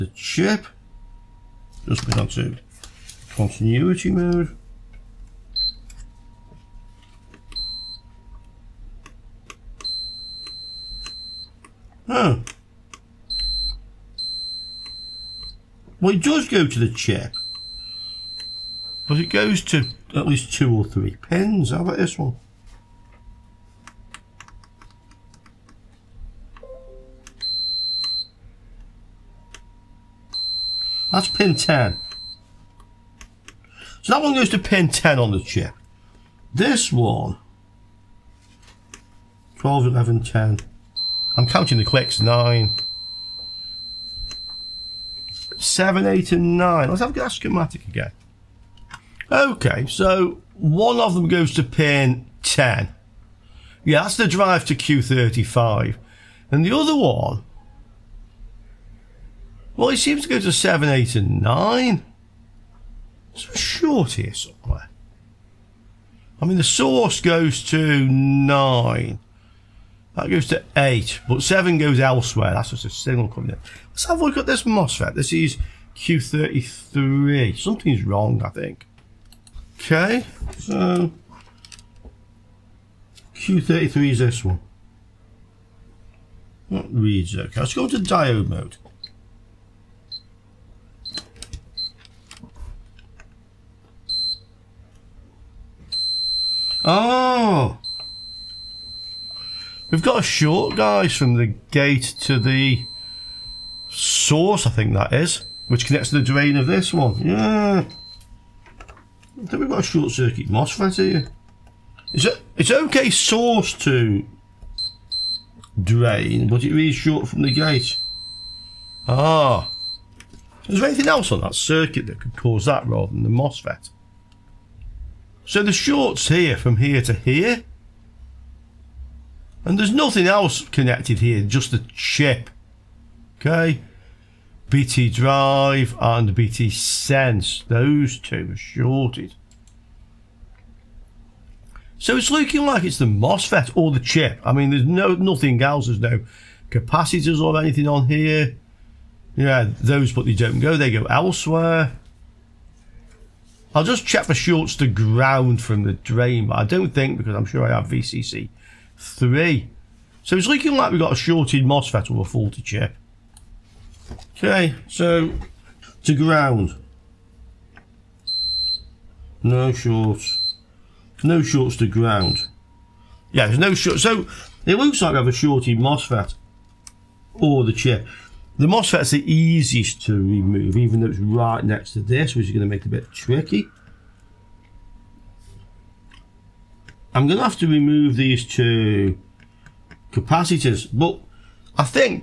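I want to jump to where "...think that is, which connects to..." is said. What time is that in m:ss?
1:44.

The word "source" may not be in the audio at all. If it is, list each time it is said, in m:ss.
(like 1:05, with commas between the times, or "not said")
1:06, 1:43, 1:53.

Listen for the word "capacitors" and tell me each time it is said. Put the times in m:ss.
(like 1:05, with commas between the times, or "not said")
2:26, 3:10.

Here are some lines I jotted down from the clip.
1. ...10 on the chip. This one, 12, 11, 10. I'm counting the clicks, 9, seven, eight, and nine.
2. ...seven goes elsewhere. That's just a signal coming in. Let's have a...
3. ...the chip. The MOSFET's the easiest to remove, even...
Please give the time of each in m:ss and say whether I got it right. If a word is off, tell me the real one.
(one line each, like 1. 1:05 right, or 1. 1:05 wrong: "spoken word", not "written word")
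1. 0:34 right
2. 1:11 right
3. 2:57 right.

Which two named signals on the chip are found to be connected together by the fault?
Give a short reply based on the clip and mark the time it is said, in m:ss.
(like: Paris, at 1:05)
BT Drive and BT Sense, at 2:14.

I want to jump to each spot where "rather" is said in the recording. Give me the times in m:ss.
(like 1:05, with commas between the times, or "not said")
2:02.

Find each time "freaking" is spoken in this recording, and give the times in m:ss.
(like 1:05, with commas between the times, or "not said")
not said.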